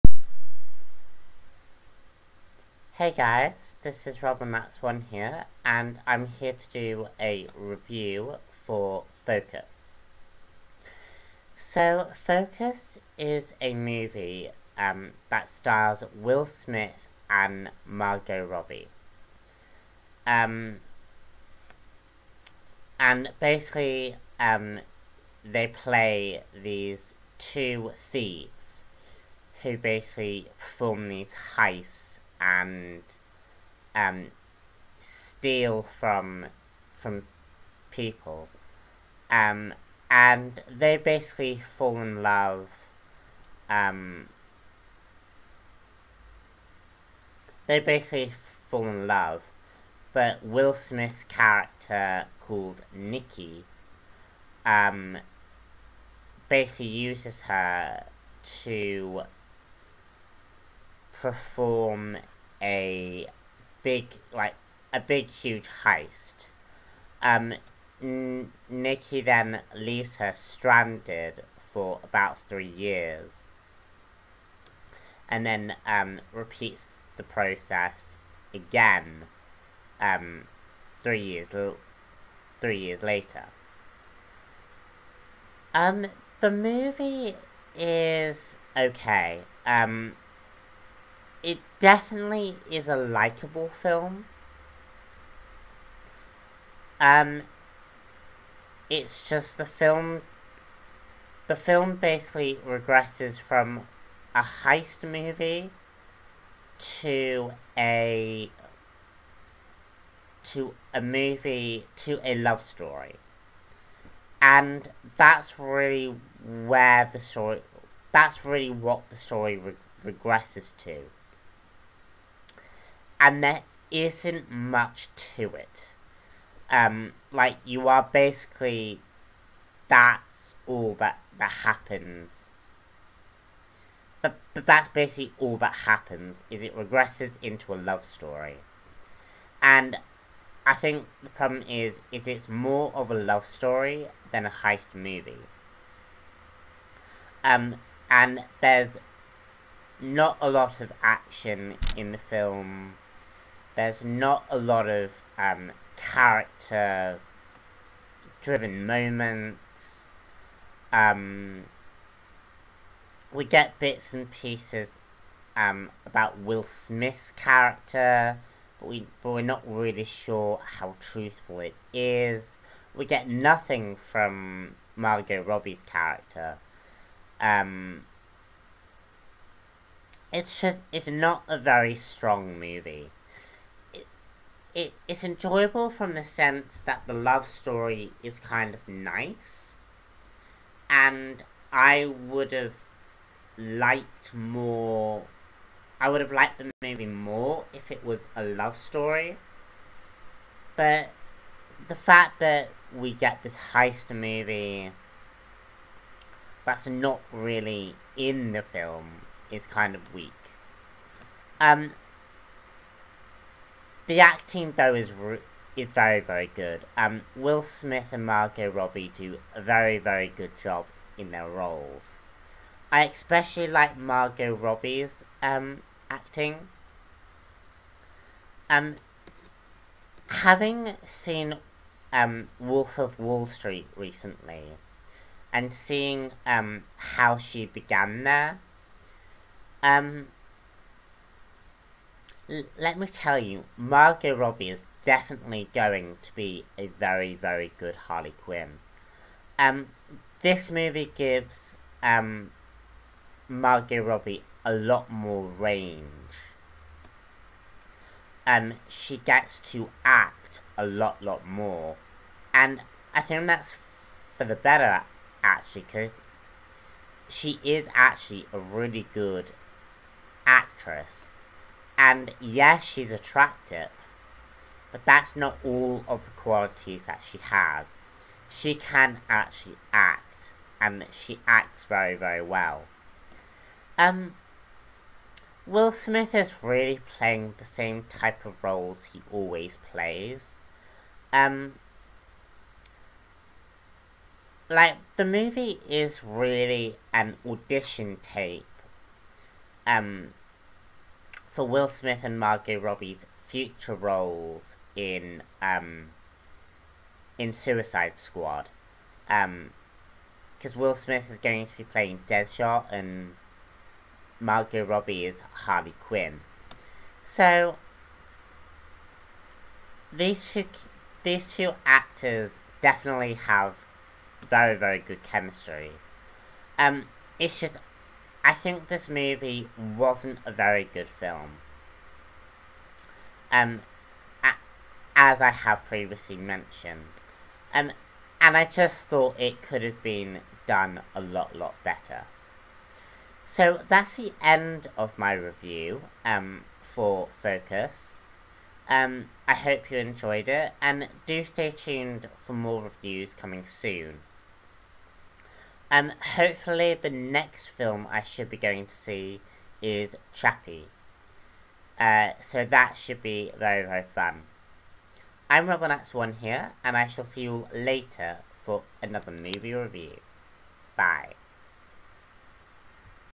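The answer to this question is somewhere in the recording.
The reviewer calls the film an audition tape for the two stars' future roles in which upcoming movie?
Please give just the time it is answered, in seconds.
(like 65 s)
307 s.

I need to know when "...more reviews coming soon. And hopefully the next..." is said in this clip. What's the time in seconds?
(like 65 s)
352 s.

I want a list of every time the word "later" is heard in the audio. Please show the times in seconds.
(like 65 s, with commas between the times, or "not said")
83 s, 367 s.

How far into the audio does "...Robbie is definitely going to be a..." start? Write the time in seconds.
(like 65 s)
244 s.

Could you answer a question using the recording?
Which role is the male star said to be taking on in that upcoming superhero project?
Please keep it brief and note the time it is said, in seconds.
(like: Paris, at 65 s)
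Deadshot, at 312 s.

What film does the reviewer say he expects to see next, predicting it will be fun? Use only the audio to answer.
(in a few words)
Chappie.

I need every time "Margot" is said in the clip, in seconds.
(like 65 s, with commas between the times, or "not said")
17 s, 174 s, 218 s, 223 s, 243 s, 253 s, 302 s, 314 s.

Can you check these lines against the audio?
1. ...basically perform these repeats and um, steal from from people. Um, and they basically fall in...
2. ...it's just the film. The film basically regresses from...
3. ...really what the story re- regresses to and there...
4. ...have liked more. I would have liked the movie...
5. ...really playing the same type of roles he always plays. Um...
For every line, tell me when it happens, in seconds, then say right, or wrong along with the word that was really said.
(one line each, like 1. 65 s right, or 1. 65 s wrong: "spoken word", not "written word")
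1. 29 s wrong: "heists", not "repeats"
2. 98 s right
3. 118 s right
4. 192 s right
5. 286 s right.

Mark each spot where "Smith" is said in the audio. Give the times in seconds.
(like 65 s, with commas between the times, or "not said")
16 s, 50 s, 166 s, 217 s, 285 s, 301 s, 310 s.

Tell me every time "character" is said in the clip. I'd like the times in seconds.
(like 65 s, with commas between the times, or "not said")
51 s, 155 s, 167 s, 175 s.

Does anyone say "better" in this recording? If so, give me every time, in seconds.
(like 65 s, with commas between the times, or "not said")
264 s, 341 s.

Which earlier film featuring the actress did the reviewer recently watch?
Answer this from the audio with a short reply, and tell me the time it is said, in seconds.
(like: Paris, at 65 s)
Wolf of Wall Street, at 232 s.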